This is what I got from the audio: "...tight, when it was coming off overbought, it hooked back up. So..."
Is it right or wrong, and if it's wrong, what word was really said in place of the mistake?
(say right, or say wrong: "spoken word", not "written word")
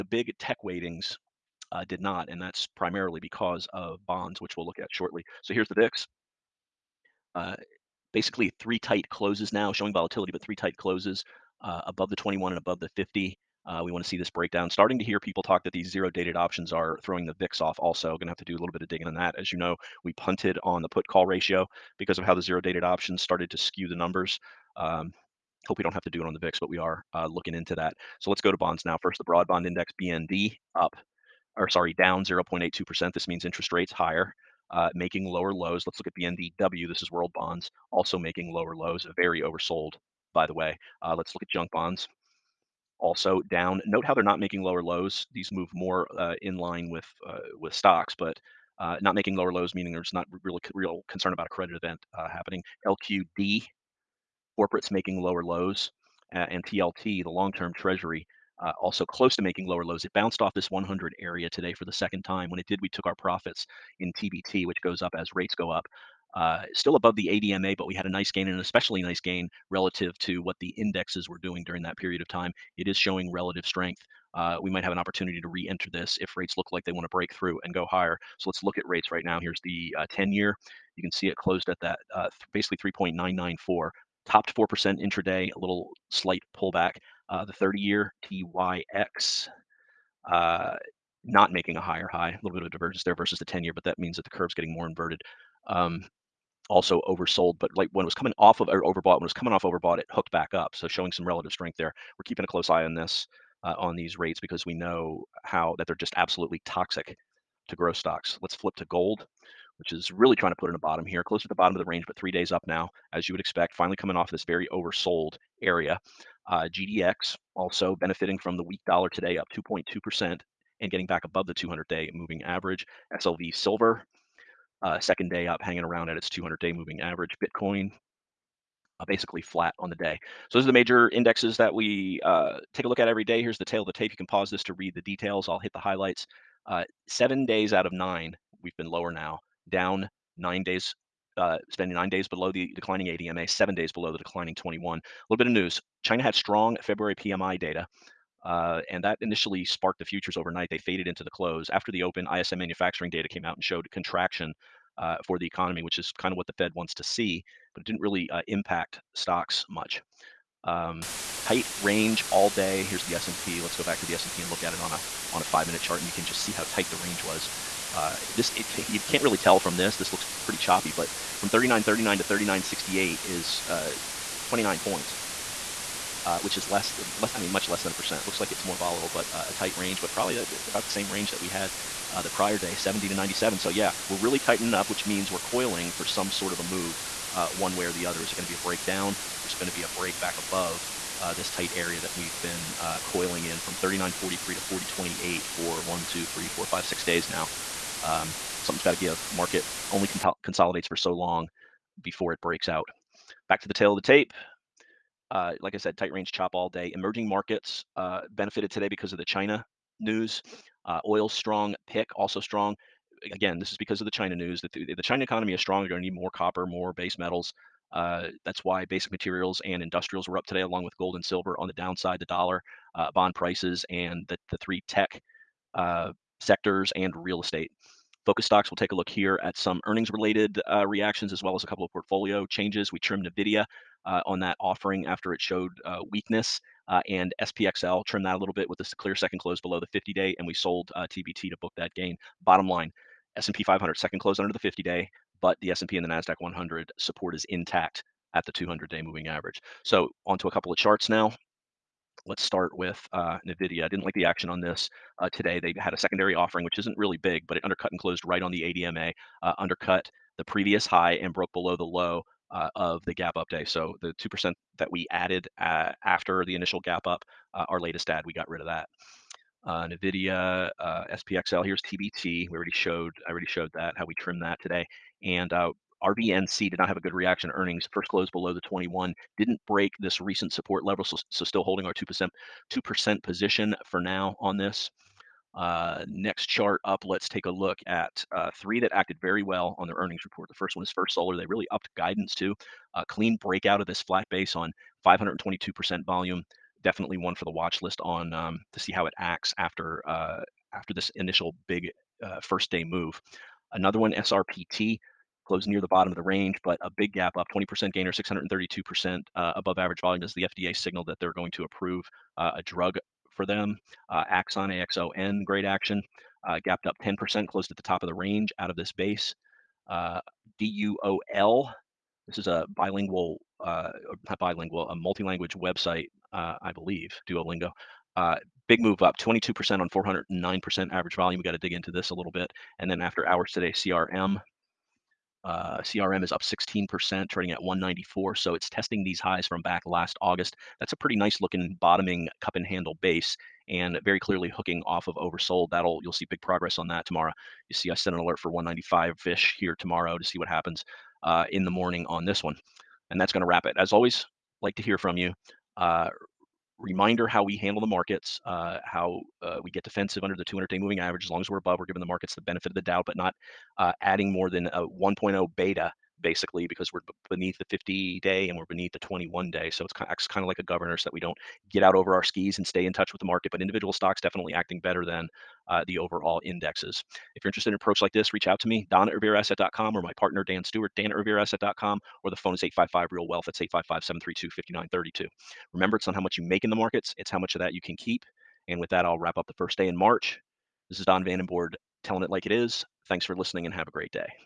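wrong: "overbought", not "tight".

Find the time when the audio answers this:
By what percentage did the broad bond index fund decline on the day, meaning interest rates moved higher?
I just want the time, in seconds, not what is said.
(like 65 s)
32 s.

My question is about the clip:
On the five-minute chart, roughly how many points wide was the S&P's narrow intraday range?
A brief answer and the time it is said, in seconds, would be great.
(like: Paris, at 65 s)
29, at 174 s.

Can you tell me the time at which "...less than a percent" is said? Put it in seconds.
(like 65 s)
177 s.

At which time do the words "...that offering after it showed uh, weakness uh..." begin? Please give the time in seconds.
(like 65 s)
234 s.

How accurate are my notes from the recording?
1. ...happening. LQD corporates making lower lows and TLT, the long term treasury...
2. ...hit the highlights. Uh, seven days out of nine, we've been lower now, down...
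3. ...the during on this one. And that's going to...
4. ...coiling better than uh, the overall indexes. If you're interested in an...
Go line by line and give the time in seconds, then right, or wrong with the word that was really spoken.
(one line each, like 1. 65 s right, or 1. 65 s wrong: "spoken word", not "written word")
1. 52 s right
2. 135 s right
3. 351 s wrong: "morning", not "during"
4. 374 s wrong: "acting", not "coiling".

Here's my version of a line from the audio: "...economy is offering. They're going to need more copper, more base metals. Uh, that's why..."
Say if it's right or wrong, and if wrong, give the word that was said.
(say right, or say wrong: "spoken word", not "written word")
wrong: "strong", not "offering".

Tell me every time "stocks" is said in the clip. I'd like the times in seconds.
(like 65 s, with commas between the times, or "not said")
47 s, 107 s, 159 s, 228 s, 373 s.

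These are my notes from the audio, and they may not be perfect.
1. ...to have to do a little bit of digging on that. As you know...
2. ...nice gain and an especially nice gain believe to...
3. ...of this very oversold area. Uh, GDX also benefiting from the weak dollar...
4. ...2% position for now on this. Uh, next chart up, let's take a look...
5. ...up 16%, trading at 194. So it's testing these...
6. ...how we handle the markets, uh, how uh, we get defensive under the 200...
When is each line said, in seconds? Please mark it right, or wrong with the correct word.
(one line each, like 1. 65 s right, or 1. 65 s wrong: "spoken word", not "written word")
1. 18 s right
2. 68 s wrong: "relative", not "believe"
3. 114 s right
4. 282 s right
5. 336 s right
6. 357 s right.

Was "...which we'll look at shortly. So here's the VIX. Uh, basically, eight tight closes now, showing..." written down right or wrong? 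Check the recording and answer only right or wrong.
wrong.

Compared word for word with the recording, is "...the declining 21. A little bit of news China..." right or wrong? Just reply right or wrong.
right.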